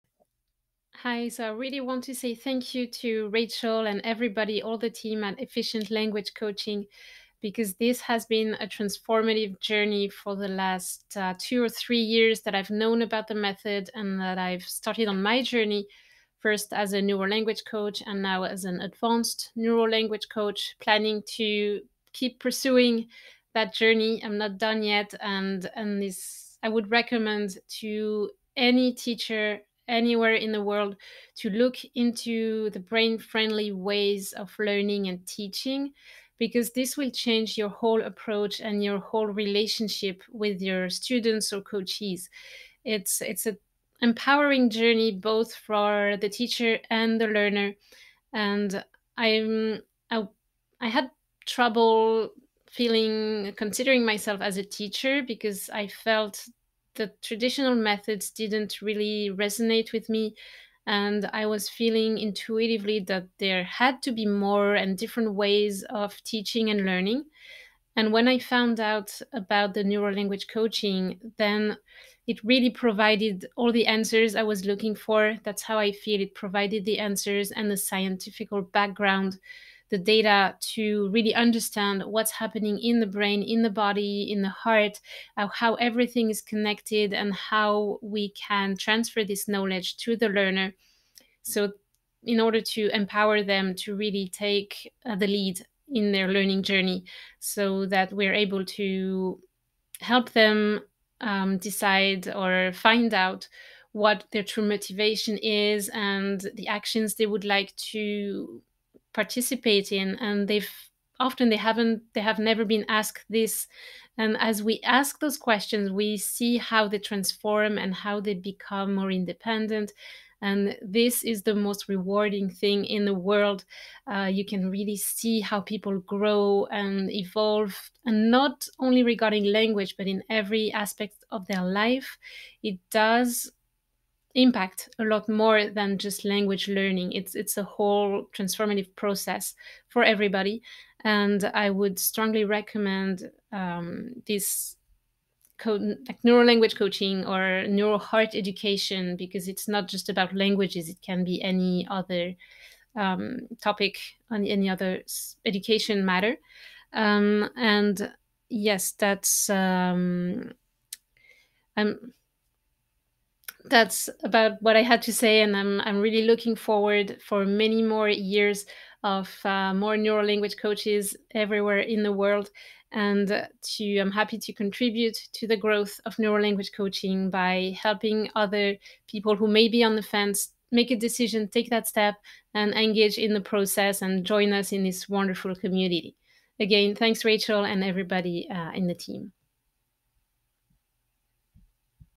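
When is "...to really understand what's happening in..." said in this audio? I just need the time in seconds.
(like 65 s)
80 s.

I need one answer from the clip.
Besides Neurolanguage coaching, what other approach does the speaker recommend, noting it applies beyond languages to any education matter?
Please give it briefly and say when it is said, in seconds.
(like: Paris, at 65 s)
NeuroHeart education, at 147 s.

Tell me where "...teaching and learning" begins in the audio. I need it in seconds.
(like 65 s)
66 s.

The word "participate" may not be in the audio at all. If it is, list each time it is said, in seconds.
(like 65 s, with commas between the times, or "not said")
109 s.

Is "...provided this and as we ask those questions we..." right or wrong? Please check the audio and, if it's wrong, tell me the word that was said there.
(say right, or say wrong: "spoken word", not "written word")
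wrong: "asked", not "provided".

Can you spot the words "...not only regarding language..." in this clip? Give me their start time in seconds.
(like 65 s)
128 s.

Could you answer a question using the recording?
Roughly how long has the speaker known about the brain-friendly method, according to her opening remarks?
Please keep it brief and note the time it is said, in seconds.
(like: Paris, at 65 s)
2 or 3 years, at 11 s.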